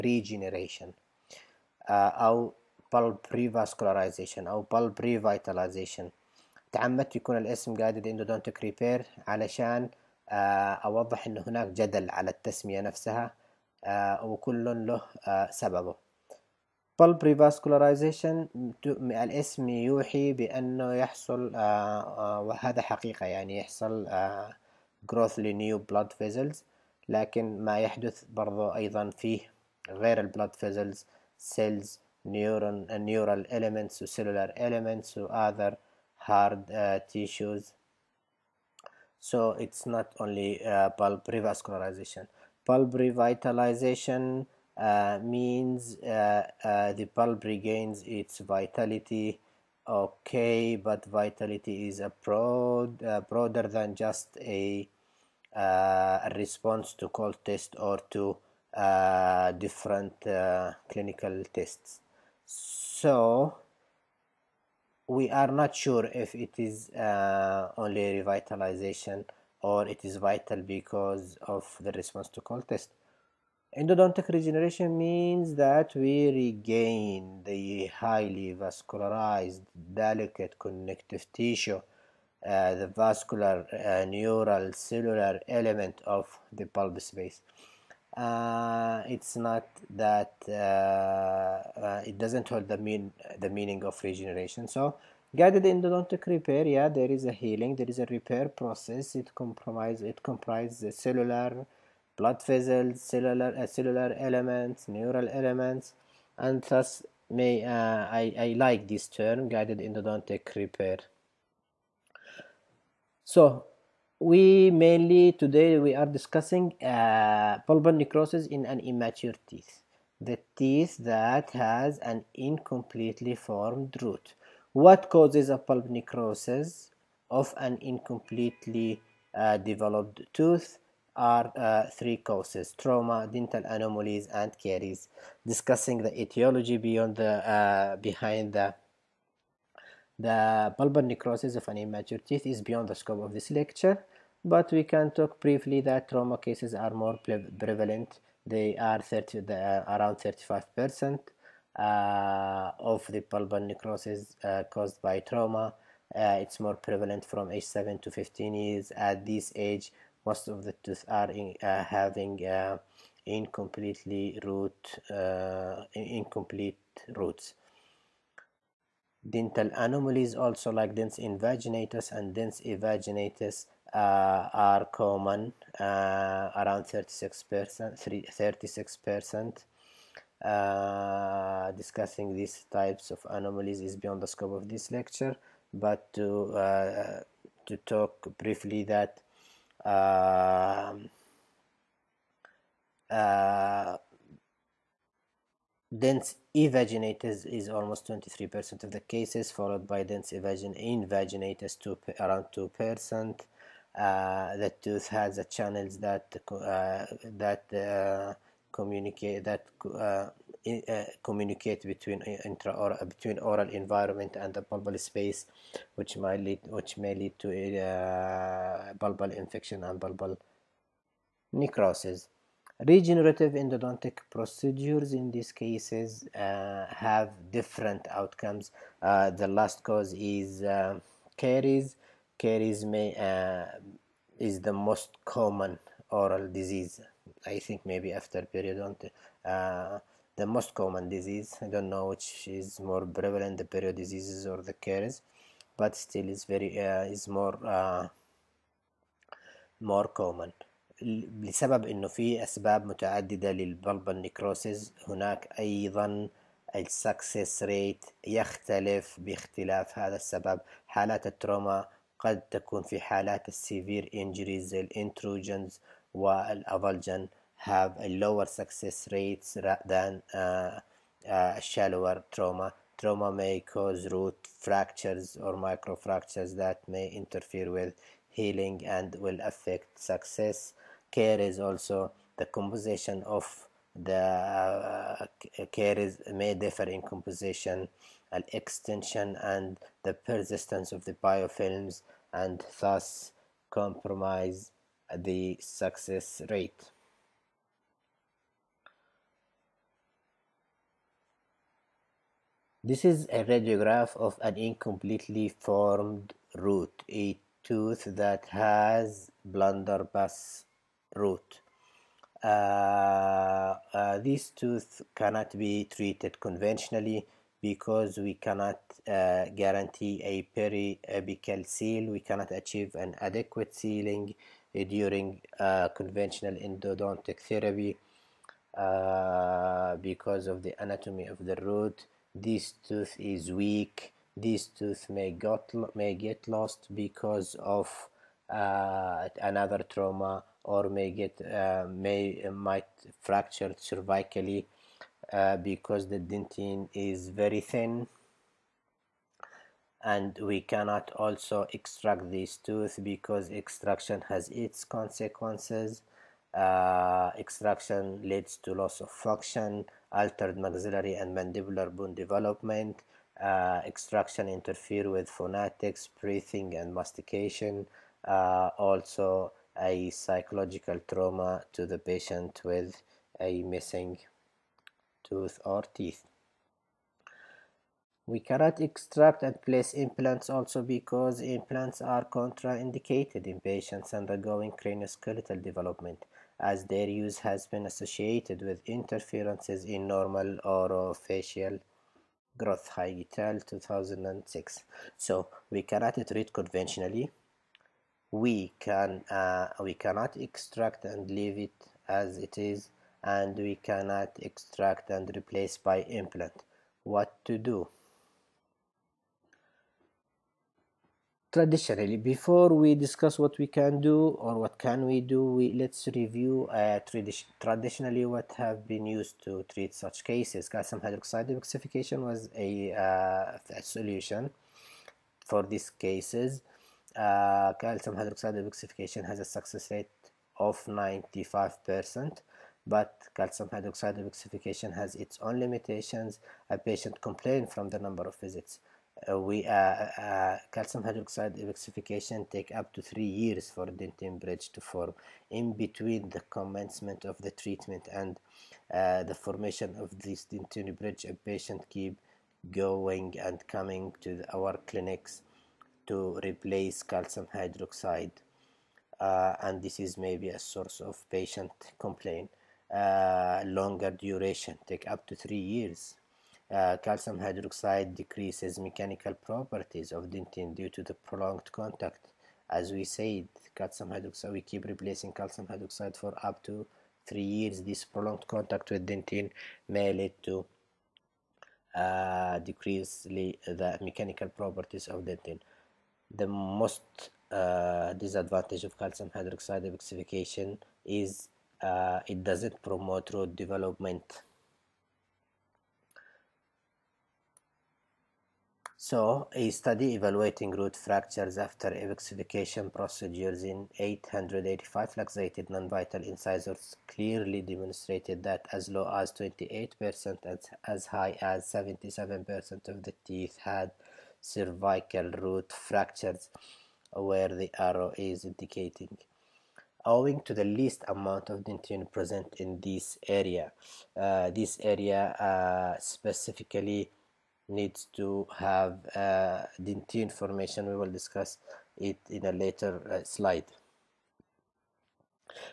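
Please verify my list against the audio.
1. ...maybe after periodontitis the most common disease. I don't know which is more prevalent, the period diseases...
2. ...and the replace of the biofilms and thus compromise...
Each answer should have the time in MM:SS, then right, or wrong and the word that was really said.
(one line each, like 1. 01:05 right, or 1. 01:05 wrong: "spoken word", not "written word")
1. 03:57 right
2. 04:49 wrong: "persistence", not "replace".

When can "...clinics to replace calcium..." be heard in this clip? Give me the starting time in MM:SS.
07:34.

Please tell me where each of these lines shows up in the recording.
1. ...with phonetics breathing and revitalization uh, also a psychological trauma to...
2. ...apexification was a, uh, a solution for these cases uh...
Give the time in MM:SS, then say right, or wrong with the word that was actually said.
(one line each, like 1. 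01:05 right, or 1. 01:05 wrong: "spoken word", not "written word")
1. 06:05 wrong: "mastication", not "revitalization"
2. 07:01 right.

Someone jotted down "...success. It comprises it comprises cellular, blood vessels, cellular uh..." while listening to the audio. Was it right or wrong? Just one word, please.
wrong.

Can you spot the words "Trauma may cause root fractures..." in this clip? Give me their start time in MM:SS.
04:33.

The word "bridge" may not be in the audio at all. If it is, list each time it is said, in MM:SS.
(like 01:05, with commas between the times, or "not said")
07:24, 07:30.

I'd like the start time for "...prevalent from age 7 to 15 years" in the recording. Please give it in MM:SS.
02:36.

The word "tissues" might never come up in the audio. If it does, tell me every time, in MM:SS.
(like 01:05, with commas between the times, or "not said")
00:37, 01:21.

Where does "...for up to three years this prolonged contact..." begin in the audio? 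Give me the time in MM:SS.
07:56.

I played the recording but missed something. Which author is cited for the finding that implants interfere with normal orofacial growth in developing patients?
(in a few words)
Heij et al.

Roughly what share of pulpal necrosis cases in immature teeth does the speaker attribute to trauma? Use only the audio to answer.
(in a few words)
35%.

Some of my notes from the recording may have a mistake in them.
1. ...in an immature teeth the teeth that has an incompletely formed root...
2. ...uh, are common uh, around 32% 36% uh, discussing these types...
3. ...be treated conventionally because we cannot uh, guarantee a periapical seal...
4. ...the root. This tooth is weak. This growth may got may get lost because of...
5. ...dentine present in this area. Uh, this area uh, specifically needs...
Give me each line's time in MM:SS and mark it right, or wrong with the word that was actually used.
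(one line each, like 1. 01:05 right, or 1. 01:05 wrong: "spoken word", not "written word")
1. 01:58 right
2. 02:53 wrong: "36", not "32"
3. 05:15 right
4. 05:31 wrong: "tooth", not "growth"
5. 08:41 right.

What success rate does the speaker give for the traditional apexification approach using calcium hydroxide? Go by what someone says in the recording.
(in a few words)
95%.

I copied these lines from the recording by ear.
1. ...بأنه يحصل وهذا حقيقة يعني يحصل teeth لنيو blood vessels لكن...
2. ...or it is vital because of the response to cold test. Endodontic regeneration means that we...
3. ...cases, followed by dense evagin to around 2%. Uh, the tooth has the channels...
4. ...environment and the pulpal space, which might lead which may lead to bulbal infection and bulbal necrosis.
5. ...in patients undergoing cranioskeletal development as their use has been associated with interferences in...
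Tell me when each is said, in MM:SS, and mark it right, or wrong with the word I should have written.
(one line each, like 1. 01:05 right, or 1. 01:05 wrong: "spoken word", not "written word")
1. 00:20 wrong: "growth", not "teeth"
2. 01:09 right
3. 03:19 right
4. 03:33 wrong: "bulbal", not "pulpal"
5. 06:23 right.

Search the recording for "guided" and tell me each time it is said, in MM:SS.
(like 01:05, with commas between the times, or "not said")
00:07, 01:35, 01:49.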